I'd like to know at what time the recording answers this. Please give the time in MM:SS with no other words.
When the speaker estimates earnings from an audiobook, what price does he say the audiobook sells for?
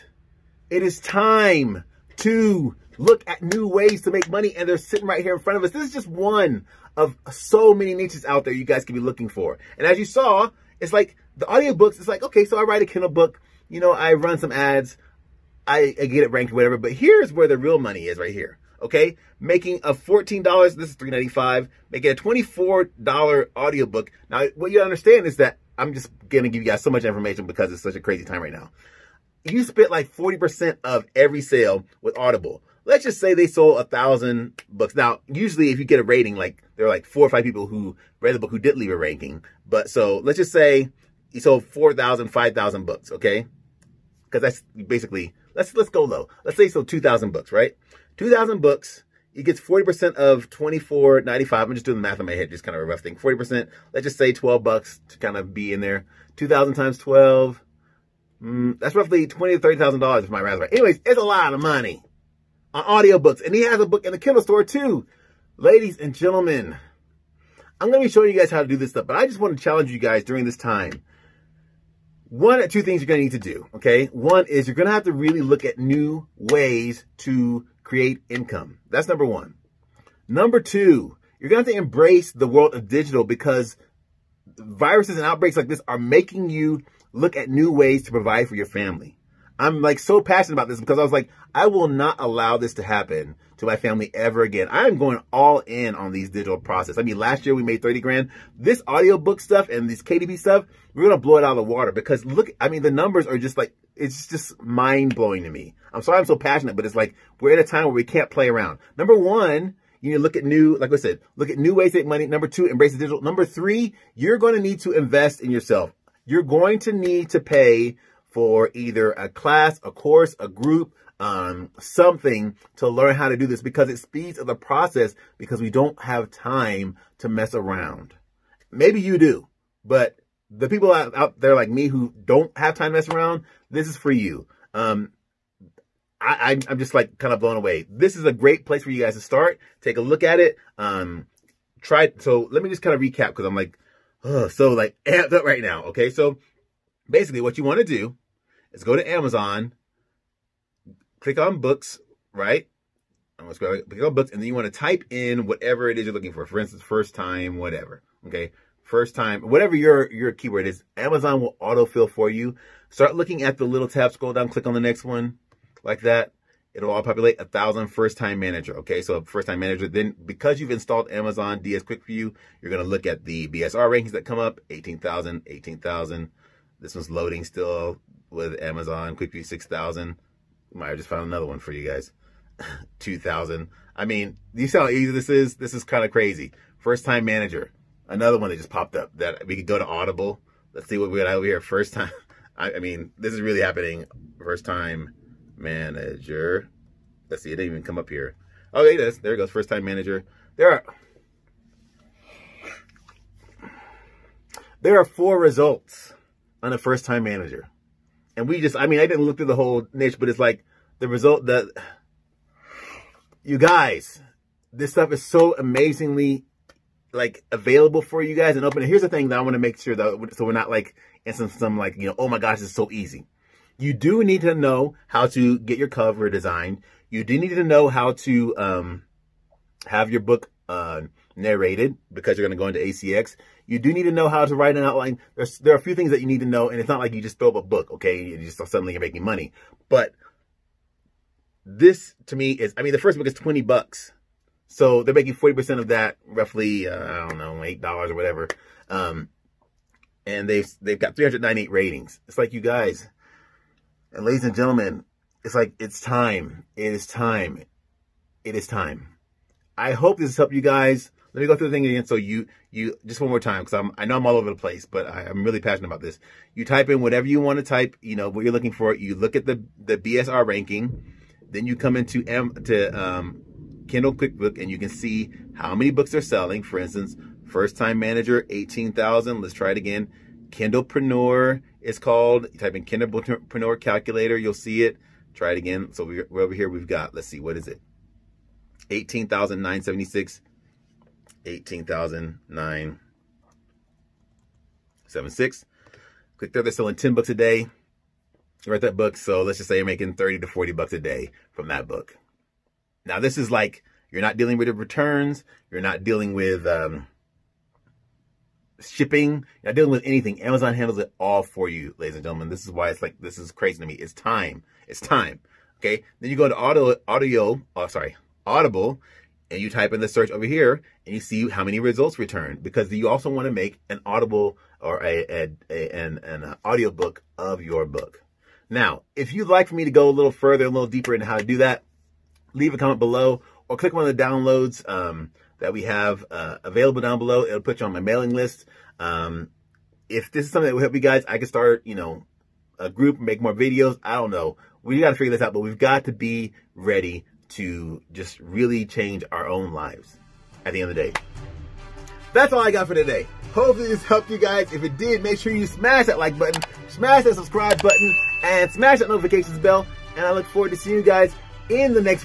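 00:21.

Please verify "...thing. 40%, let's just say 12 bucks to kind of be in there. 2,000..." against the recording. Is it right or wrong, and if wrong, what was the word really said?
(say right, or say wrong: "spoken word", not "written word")
right.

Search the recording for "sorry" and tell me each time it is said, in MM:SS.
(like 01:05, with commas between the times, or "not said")
01:46, 05:17.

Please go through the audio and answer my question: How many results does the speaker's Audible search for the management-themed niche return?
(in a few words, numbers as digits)
4.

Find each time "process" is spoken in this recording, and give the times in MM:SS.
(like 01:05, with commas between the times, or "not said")
01:36, 02:04.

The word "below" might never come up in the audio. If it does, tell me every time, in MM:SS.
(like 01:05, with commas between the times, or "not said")
05:32, 05:37.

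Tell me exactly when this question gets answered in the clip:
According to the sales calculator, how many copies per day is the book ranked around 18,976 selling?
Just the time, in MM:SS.
04:56.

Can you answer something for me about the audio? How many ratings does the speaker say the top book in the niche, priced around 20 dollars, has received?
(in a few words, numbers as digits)
398.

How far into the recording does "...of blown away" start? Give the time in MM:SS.
02:17.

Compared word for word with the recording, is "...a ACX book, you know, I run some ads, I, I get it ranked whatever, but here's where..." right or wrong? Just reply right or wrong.
wrong.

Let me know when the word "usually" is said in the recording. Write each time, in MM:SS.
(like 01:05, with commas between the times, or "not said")
00:35.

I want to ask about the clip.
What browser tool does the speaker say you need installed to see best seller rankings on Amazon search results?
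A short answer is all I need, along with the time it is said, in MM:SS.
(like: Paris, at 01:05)
Amazon DS Quick View, at 02:51.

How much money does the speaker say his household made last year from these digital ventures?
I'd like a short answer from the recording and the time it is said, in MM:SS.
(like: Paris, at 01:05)
30 grand, at 01:37.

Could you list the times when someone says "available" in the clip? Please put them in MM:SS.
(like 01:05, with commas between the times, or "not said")
03:37, 05:36.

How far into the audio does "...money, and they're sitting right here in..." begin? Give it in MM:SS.
00:04.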